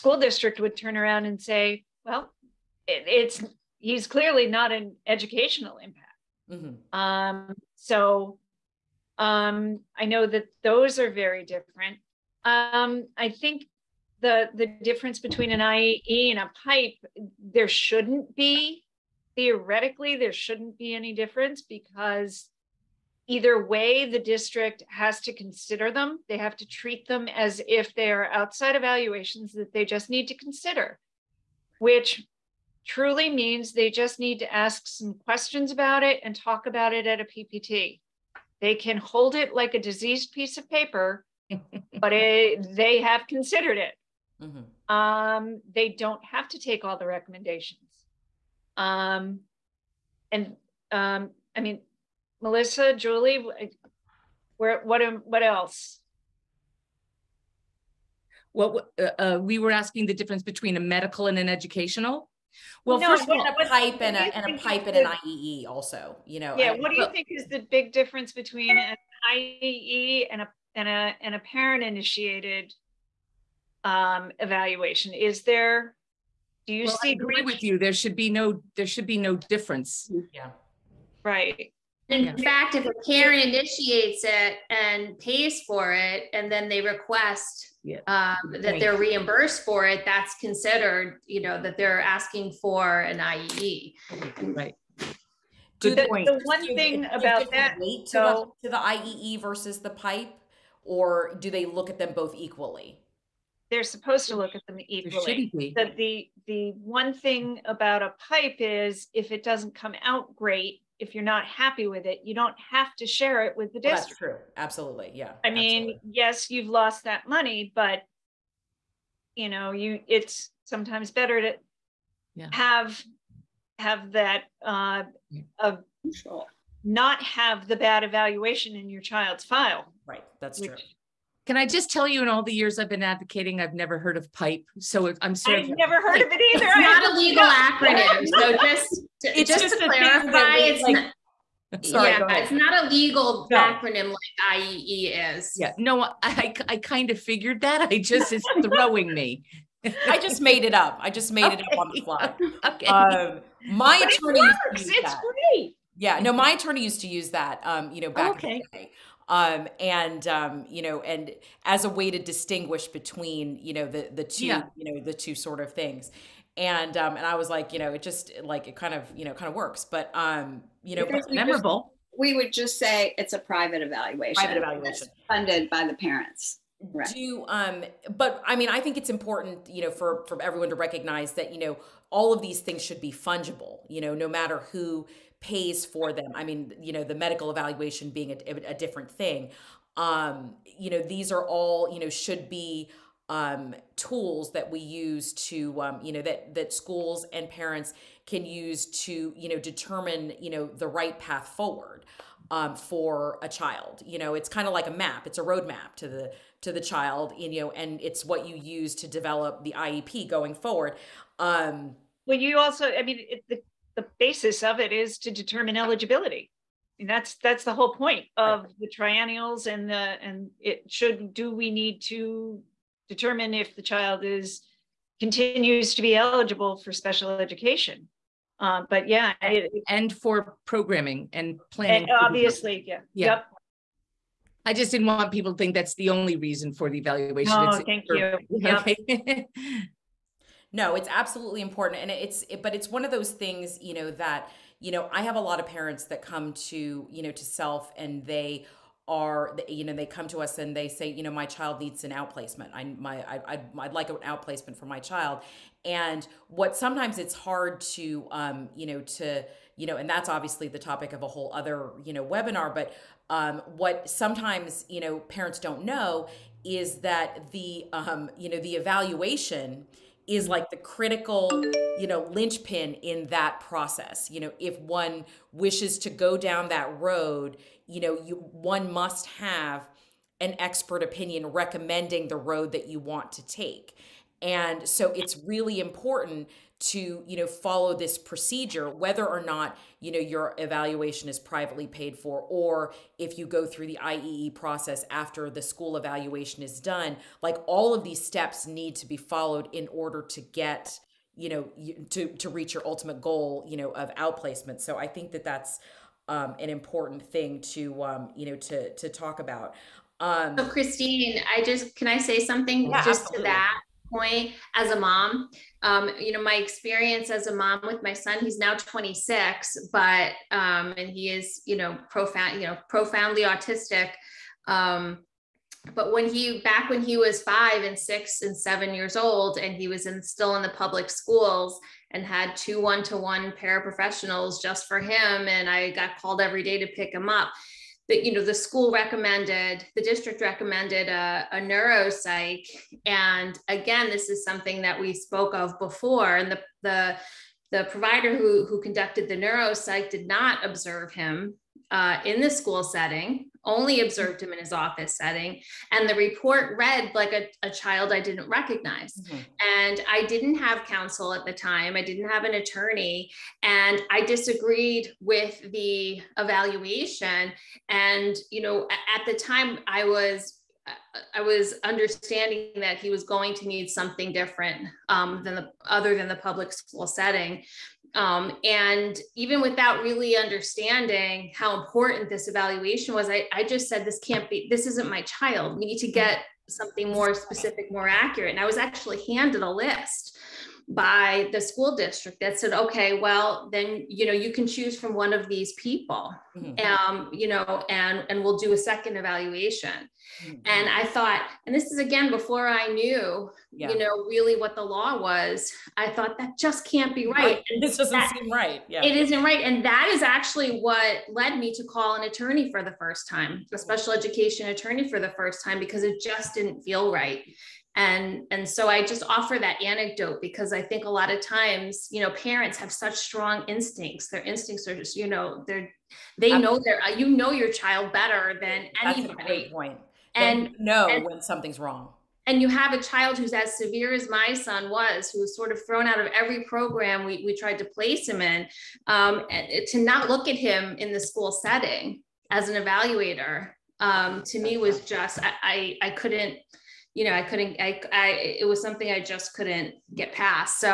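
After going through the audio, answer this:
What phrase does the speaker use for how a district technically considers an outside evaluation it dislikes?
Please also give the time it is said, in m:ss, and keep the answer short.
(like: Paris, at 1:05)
diseased piece of paper, at 0:39.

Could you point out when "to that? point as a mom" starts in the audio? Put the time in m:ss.
5:13.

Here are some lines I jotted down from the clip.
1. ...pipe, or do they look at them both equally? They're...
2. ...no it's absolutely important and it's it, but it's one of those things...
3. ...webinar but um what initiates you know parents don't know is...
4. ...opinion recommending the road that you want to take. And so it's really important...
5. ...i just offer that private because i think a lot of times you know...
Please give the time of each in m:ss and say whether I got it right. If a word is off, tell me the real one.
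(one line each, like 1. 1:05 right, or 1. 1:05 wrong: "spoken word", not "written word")
1. 1:39 right
2. 4:00 right
3. 4:22 wrong: "sometimes", not "initiates"
4. 4:41 right
5. 6:58 wrong: "anecdote", not "private".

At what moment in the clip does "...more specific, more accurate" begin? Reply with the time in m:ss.
6:27.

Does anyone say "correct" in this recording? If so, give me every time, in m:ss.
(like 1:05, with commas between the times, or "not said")
not said.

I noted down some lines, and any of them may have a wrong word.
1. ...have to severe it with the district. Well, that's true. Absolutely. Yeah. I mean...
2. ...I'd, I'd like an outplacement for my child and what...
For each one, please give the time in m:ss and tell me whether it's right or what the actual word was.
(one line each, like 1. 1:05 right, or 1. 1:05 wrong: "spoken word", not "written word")
1. 1:52 wrong: "share", not "severe"
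2. 4:13 right.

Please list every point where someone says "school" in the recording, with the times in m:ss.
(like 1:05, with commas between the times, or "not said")
3:16, 4:55, 5:31, 5:38, 5:52, 6:16, 6:31, 7:21.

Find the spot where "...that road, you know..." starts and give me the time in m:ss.
4:36.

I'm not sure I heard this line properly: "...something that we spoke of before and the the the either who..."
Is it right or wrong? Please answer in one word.
wrong.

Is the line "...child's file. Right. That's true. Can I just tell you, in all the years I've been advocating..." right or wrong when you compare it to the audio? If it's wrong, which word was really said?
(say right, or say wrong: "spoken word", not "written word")
right.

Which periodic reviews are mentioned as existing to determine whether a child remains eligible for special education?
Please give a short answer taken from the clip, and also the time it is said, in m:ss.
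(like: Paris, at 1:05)
triennials, at 3:38.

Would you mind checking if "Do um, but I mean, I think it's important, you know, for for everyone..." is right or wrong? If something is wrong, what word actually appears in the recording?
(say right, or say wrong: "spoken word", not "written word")
right.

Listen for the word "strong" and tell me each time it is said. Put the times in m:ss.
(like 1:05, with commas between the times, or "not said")
7:03.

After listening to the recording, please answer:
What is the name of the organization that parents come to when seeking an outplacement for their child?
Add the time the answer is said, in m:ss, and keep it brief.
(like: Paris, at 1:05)
SELF, at 4:07.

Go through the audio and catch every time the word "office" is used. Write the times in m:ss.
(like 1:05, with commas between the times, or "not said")
5:54.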